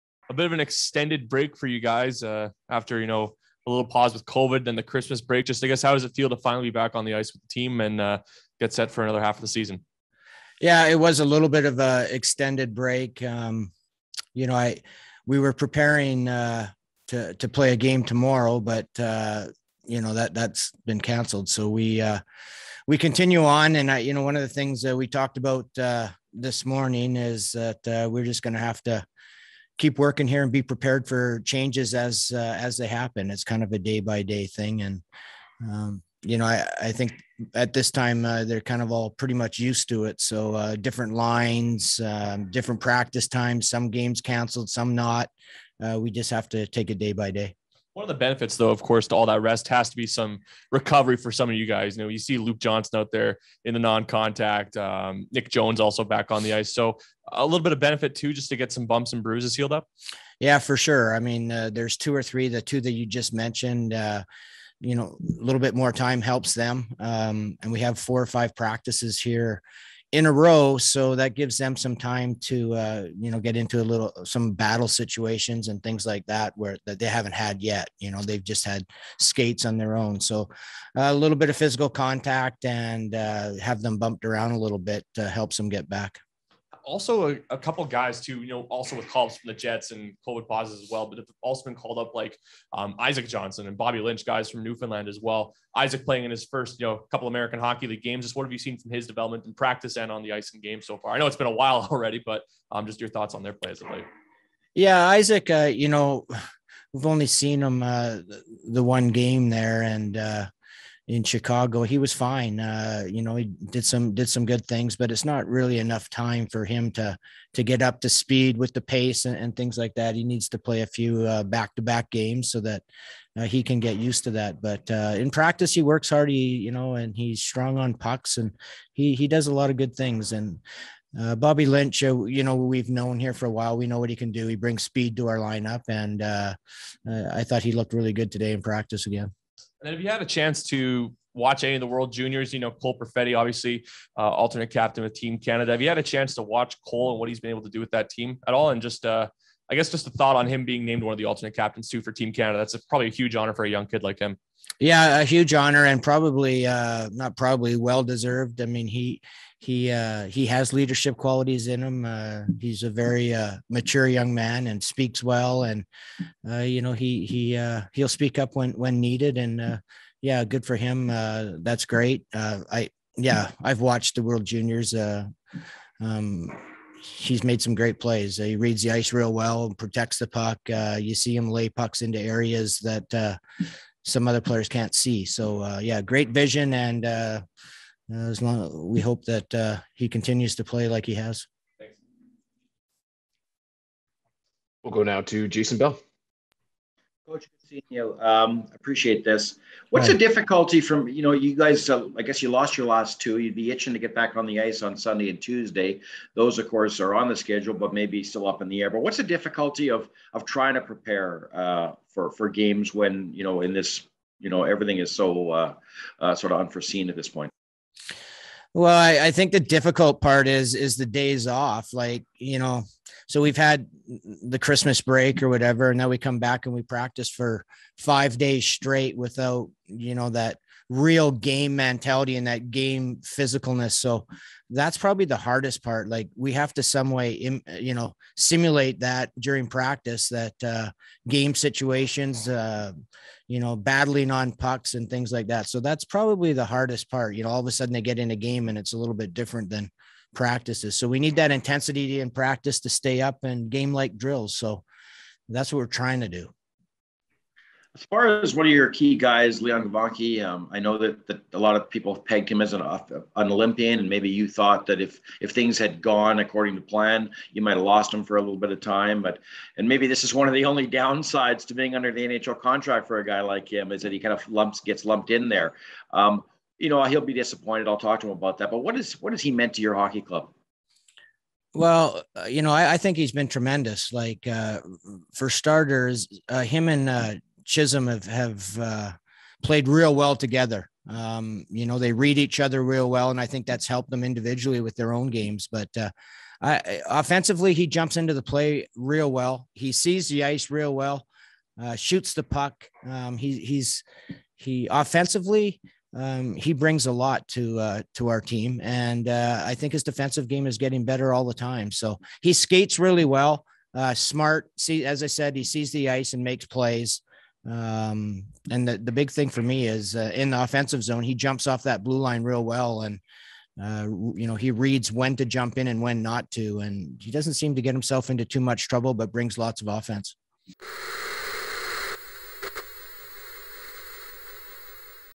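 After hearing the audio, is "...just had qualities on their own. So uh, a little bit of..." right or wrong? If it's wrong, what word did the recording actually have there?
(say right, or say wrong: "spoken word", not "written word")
wrong: "skates", not "qualities".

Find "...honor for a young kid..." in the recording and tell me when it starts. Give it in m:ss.
2:33.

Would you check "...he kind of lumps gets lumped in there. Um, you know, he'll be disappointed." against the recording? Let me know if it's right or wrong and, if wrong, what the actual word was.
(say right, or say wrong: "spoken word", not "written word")
right.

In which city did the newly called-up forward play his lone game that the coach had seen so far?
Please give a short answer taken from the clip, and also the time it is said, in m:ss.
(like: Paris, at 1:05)
Chicago, at 1:51.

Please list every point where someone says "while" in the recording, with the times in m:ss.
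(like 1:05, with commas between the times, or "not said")
1:41, 2:13.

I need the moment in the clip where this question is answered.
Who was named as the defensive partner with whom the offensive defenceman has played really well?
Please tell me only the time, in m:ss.
4:47.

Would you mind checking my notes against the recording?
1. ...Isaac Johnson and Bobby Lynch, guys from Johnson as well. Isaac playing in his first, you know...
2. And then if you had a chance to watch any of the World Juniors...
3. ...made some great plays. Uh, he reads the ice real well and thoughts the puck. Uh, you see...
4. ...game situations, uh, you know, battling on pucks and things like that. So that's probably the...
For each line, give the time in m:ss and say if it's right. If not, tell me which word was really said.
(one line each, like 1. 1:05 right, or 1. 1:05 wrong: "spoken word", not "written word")
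1. 1:32 wrong: "Newfoundland", not "Johnson"
2. 2:19 right
3. 2:57 wrong: "protects", not "thoughts"
4. 4:01 right.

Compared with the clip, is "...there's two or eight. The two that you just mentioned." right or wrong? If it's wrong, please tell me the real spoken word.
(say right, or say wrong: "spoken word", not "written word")
wrong: "three", not "eight".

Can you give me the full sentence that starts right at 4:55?
But uh, I, offensively, he jumps into the play real well.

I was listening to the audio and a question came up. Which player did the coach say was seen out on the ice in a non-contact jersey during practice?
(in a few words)
Luke Johnson.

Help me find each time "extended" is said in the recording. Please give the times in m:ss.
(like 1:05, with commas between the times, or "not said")
0:00, 0:12.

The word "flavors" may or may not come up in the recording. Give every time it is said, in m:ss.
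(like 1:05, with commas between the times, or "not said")
not said.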